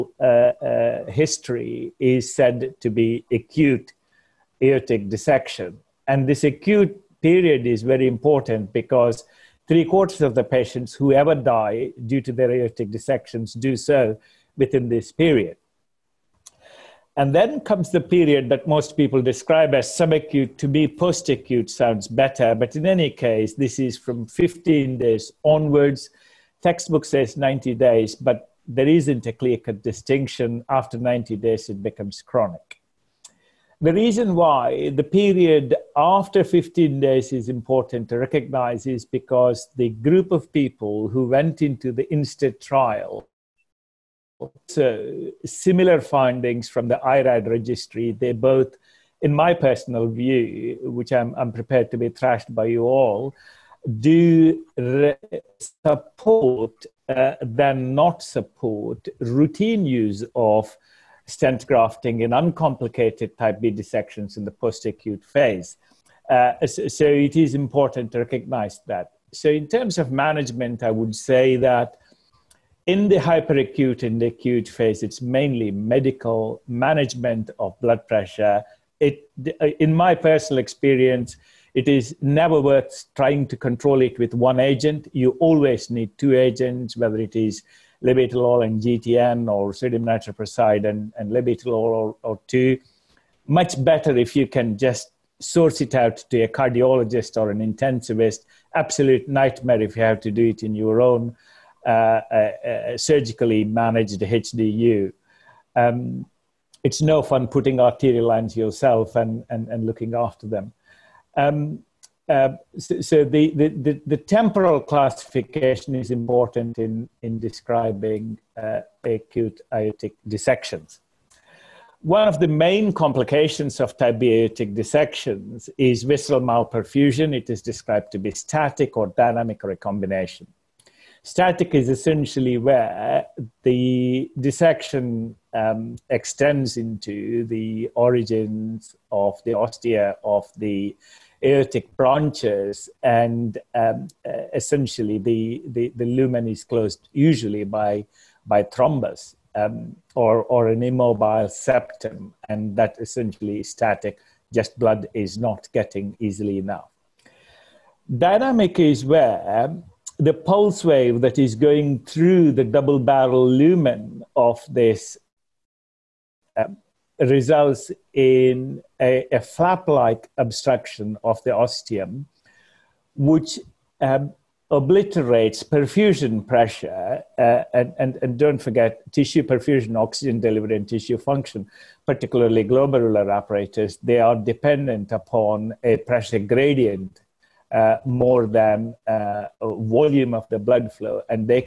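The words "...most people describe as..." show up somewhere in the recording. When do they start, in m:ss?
0:18.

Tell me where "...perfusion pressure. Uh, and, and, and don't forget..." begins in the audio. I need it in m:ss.
2:55.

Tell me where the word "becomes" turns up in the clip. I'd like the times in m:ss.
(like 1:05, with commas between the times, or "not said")
0:31.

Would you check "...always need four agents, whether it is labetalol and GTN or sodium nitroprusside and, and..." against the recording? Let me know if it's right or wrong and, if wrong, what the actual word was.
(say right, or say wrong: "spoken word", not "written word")
wrong: "two", not "four".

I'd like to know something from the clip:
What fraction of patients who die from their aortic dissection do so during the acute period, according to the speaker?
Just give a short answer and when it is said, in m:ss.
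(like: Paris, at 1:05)
Three quarters, at 0:09.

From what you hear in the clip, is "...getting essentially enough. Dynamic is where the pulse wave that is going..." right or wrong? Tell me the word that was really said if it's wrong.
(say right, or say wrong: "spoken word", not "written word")
wrong: "easily", not "essentially".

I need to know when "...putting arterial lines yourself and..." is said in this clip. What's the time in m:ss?
1:47.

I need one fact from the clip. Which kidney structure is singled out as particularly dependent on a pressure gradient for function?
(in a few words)
Glomerular apparatus.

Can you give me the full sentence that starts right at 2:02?
One of the main complications of aortic dissections is vessel malperfusion.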